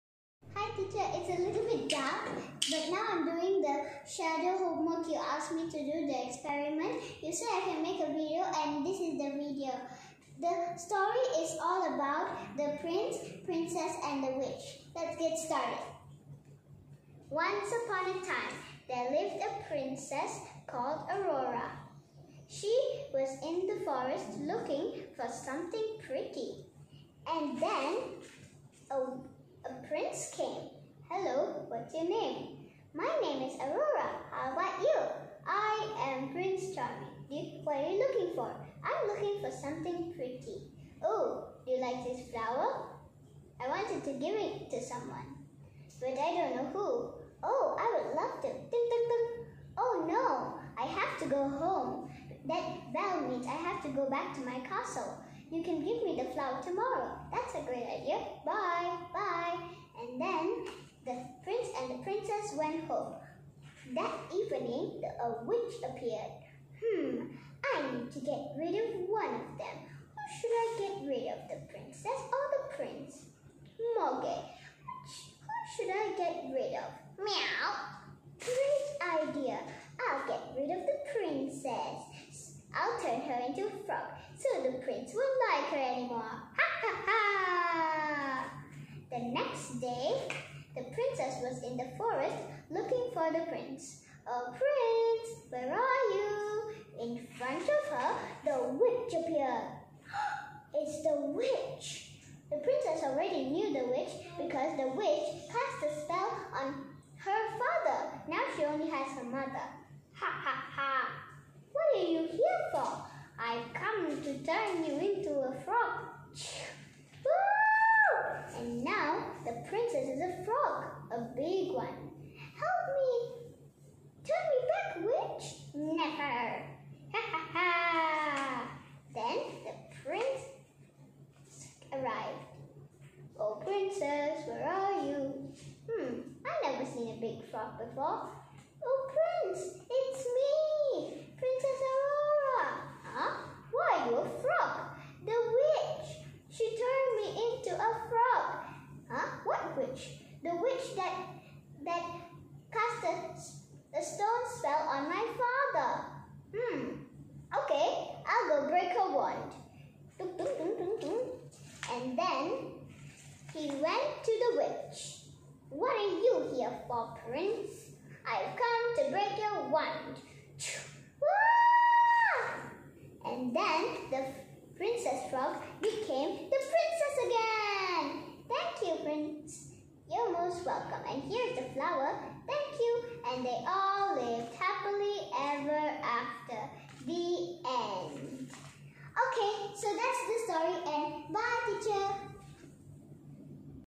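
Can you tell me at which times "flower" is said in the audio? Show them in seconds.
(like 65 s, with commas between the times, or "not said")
42 s, 56 s, 181 s.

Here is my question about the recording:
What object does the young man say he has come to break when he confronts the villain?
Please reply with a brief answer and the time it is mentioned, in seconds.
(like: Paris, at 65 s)
wand, at 169 s.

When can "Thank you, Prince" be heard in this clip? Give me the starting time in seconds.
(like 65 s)
178 s.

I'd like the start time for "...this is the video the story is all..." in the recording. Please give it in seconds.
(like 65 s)
8 s.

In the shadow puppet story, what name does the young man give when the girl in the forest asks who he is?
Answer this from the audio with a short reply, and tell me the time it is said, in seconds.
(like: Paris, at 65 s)
Prince Charming, at 36 s.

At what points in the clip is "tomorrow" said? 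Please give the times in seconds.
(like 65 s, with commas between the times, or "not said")
56 s.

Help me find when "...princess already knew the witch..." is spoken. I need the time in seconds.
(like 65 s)
102 s.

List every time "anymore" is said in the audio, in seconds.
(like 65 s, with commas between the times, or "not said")
85 s.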